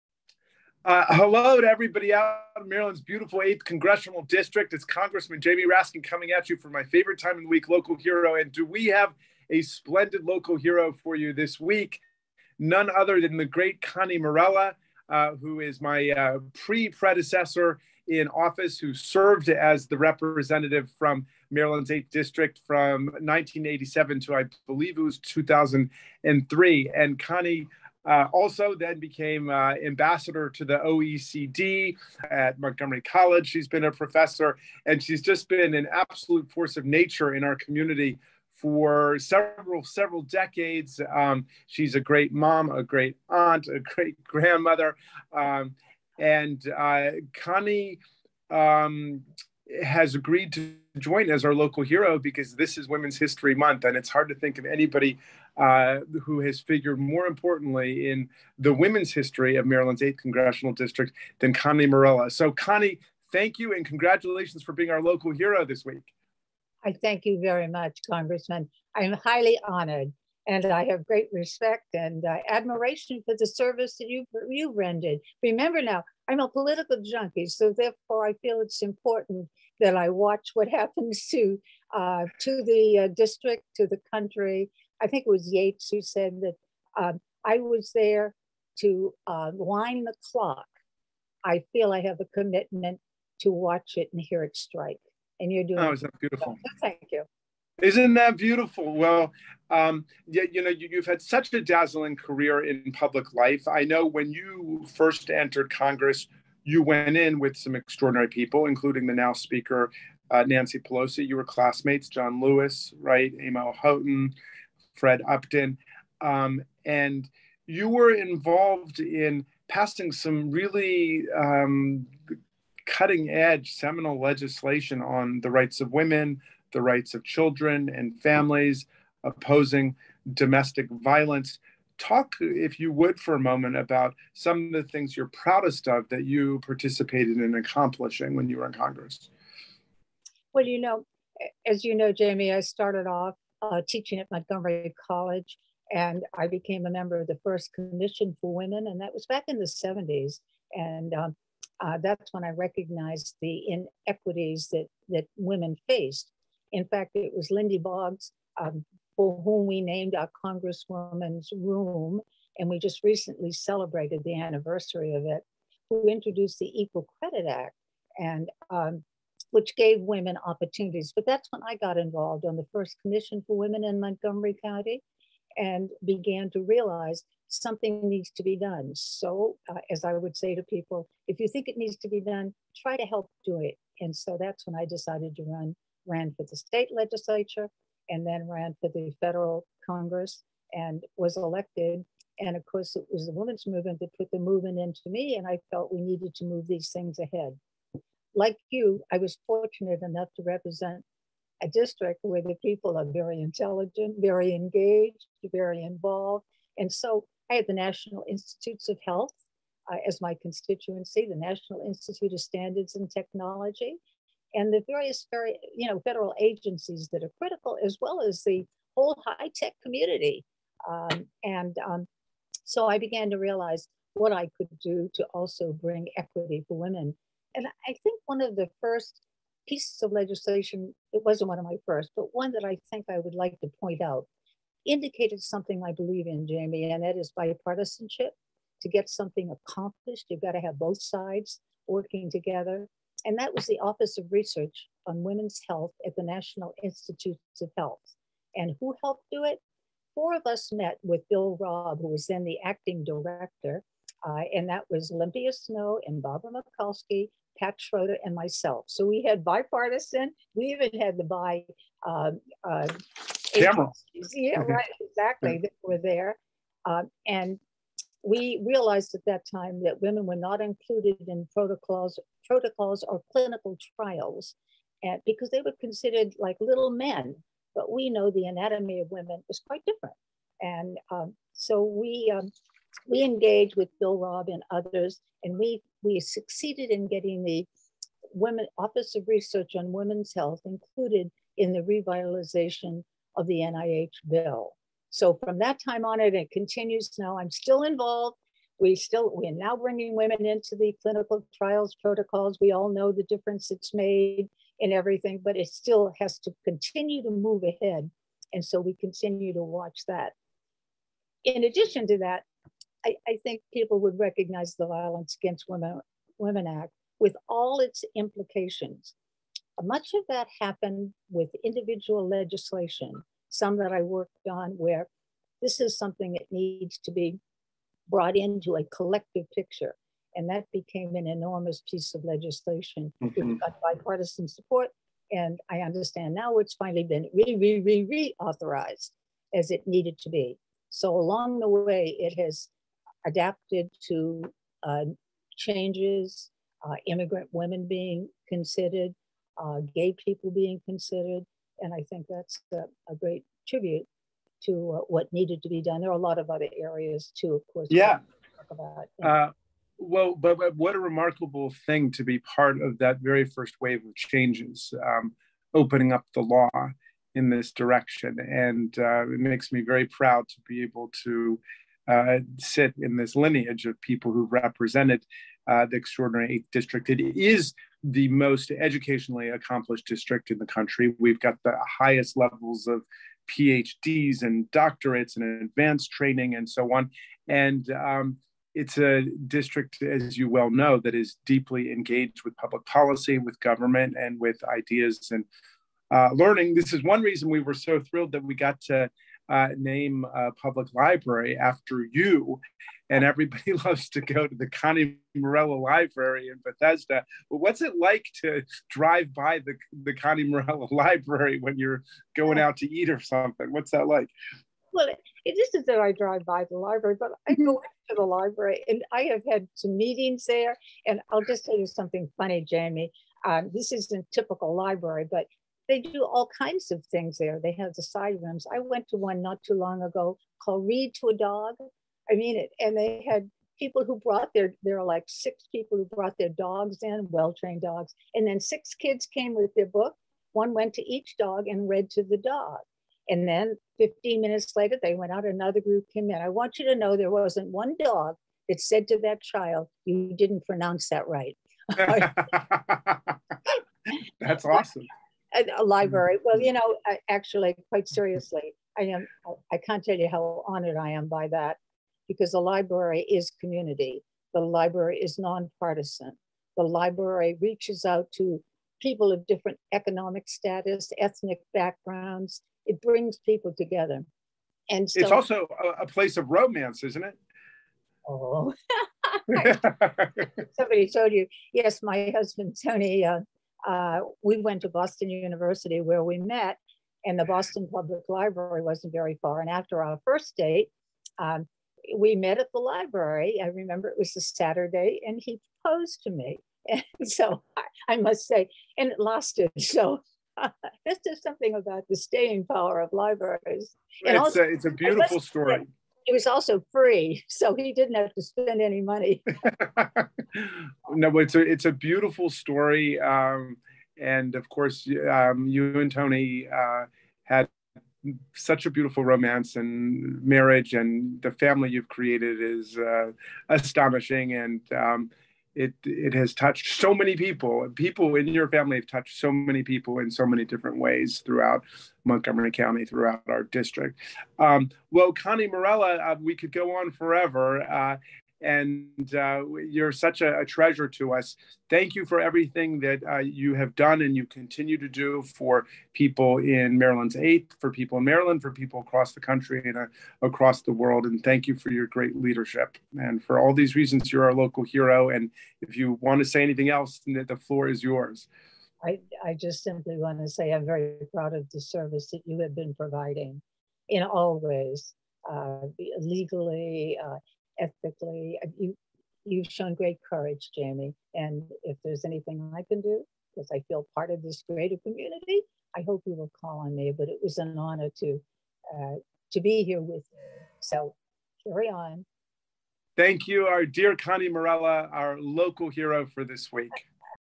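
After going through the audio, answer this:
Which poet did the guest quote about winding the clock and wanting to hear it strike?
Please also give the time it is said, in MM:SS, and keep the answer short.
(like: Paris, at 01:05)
Yates, at 01:25.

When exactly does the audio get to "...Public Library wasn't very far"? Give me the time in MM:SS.
08:07.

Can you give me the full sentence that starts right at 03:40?
Um, and um, so I began to realize what I could do to also bring equity for women.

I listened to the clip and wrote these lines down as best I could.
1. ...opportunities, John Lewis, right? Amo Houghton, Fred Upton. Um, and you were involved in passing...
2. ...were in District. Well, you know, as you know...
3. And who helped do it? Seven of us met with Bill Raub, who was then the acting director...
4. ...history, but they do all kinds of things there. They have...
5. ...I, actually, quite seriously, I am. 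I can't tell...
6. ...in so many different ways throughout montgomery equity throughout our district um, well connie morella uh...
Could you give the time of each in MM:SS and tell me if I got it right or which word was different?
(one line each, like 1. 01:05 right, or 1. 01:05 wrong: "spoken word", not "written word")
1. 01:51 wrong: "classmates", not "opportunities"
2. 02:18 wrong: "Congress", not "District"
3. 04:08 wrong: "Four", not "Seven"
4. 07:04 wrong: "library", not "history"
5. 07:37 right
6. 08:50 wrong: "county", not "equity".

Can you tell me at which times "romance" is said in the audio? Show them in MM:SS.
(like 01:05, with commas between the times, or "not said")
07:56, 08:39.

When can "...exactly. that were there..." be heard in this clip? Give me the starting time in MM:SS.
04:25.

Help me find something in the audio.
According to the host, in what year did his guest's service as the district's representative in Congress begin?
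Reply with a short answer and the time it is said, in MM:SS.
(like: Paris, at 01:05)
1987, at 00:23.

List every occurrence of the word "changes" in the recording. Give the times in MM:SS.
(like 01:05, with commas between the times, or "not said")
05:45, 06:04.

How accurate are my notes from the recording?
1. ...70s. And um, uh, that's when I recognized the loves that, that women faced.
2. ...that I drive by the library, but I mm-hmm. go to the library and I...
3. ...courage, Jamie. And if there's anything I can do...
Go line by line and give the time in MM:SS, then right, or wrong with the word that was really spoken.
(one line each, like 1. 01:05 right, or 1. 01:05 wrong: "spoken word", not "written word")
1. 02:29 wrong: "inequities", not "loves"
2. 06:55 right
3. 09:30 right.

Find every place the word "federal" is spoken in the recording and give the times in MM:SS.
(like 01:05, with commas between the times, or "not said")
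03:09, 03:36.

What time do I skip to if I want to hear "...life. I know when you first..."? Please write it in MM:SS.
01:43.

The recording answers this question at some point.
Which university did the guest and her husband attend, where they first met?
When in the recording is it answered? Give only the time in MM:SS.
08:04.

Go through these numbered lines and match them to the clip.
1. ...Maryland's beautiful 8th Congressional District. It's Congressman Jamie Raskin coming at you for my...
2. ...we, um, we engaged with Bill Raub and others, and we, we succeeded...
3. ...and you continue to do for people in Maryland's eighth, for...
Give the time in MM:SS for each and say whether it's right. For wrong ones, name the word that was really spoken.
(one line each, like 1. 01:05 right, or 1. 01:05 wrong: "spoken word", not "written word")
1. 00:02 right
2. 04:41 right
3. 09:04 right.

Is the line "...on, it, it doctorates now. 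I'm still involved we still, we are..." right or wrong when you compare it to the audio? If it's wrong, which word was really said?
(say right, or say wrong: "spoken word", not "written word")
wrong: "continues", not "doctorates".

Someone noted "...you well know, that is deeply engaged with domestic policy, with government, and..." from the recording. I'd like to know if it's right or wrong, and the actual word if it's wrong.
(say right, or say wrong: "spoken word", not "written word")
wrong: "public", not "domestic".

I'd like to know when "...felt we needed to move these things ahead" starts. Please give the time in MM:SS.
03:15.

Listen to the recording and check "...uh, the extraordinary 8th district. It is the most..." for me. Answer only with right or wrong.
right.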